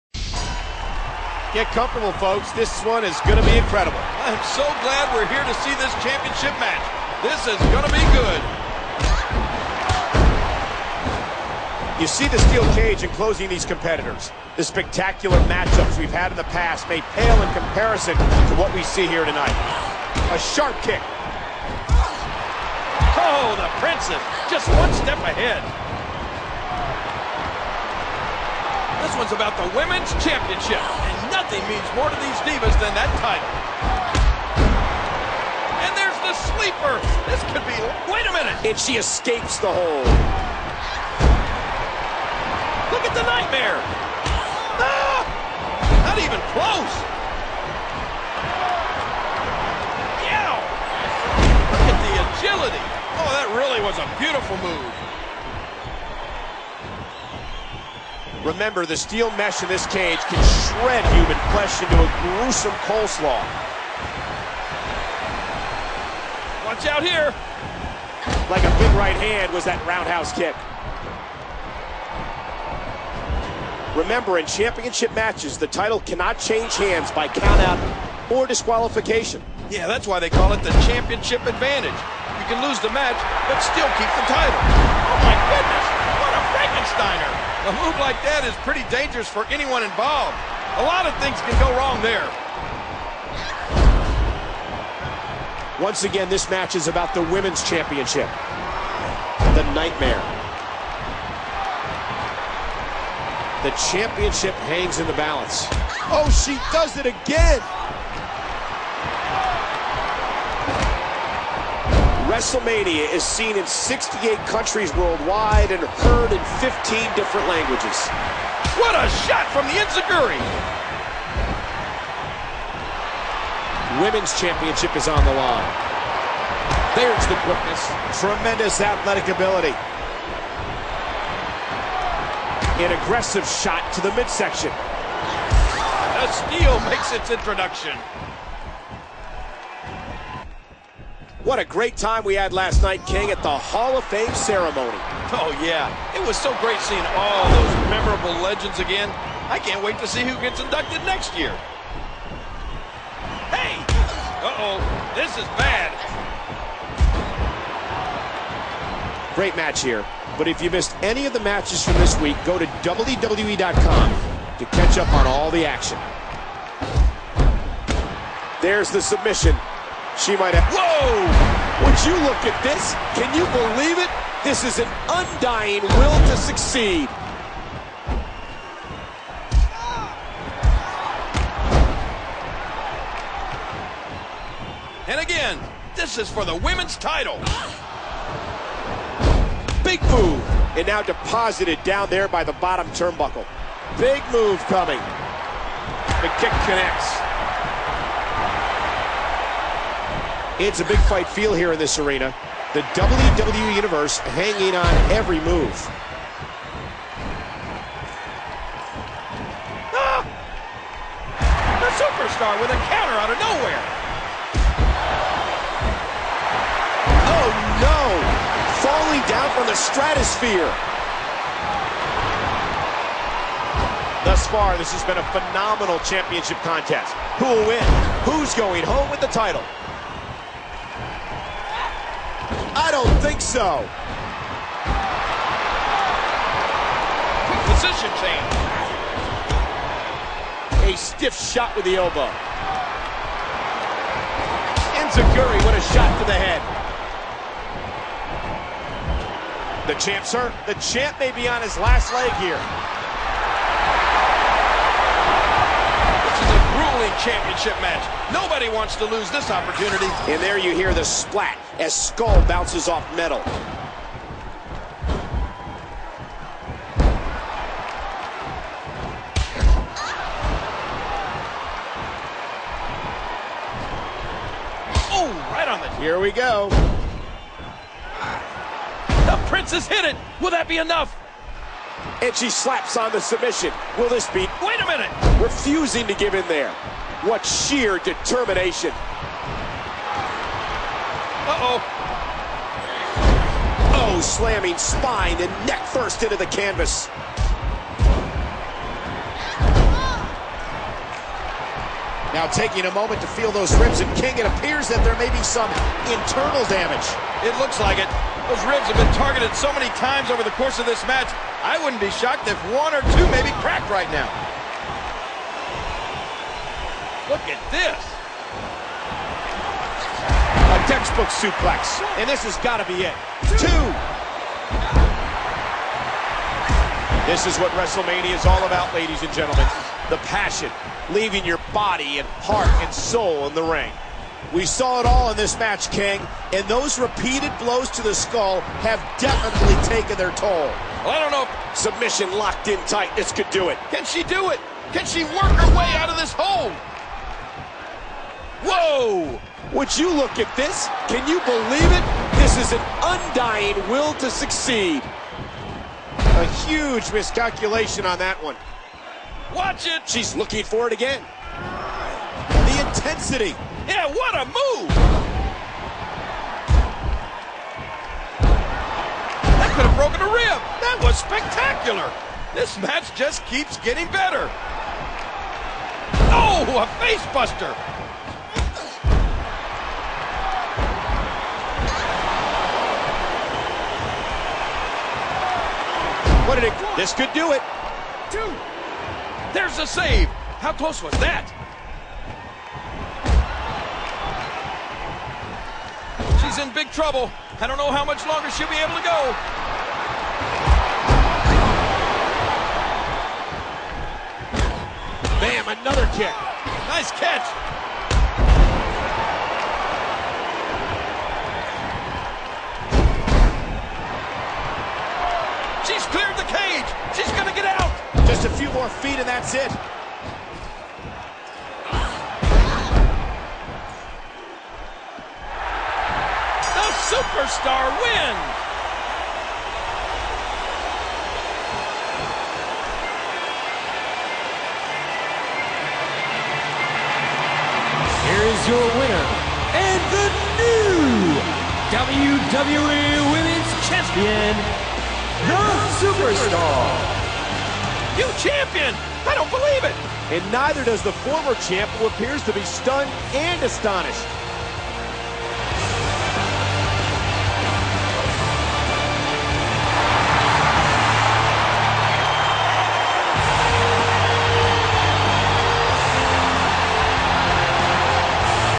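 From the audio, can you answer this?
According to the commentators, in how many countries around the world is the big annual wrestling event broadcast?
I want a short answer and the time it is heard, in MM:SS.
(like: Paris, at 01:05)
68, at 01:53.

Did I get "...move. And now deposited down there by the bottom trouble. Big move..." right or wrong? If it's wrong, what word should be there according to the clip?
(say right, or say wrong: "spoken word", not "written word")
wrong: "turnbuckle", not "trouble".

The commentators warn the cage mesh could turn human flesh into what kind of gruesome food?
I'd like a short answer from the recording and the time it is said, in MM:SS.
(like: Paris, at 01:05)
coleslaw, at 01:02.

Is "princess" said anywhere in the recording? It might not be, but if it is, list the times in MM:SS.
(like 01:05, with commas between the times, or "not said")
00:23, 04:39.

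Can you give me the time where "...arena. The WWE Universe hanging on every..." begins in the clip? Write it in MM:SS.
03:21.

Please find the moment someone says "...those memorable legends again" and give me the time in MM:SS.
02:27.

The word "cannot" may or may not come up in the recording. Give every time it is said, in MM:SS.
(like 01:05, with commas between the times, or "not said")
01:15.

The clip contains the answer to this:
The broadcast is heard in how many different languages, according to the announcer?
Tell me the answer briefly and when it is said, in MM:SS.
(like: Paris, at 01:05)
15, at 01:56.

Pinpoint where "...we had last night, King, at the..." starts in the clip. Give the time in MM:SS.
02:22.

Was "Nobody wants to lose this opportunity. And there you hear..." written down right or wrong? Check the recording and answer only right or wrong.
right.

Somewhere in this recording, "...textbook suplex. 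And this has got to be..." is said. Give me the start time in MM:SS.
05:20.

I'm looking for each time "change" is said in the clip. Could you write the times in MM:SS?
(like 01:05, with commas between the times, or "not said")
01:16, 03:58.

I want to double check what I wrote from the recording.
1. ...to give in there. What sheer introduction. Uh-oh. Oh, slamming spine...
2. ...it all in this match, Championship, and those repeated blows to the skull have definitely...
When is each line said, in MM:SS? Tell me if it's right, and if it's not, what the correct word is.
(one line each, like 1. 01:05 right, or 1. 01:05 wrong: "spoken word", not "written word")
1. 04:46 wrong: "determination", not "introduction"
2. 05:34 wrong: "King", not "Championship".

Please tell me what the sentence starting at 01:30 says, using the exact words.
A lot of things can go wrong there.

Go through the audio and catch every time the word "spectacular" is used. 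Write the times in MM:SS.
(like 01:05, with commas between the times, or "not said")
00:14, 06:11.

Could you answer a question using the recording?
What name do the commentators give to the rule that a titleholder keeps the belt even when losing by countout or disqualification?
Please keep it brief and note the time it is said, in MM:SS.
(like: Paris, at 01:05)
championship advantage, at 01:20.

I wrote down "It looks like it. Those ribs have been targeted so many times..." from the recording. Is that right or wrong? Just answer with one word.
right.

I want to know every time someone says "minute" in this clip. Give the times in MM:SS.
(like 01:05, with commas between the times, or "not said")
00:38, 04:44.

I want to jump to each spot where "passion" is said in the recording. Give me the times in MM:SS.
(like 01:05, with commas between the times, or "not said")
05:30.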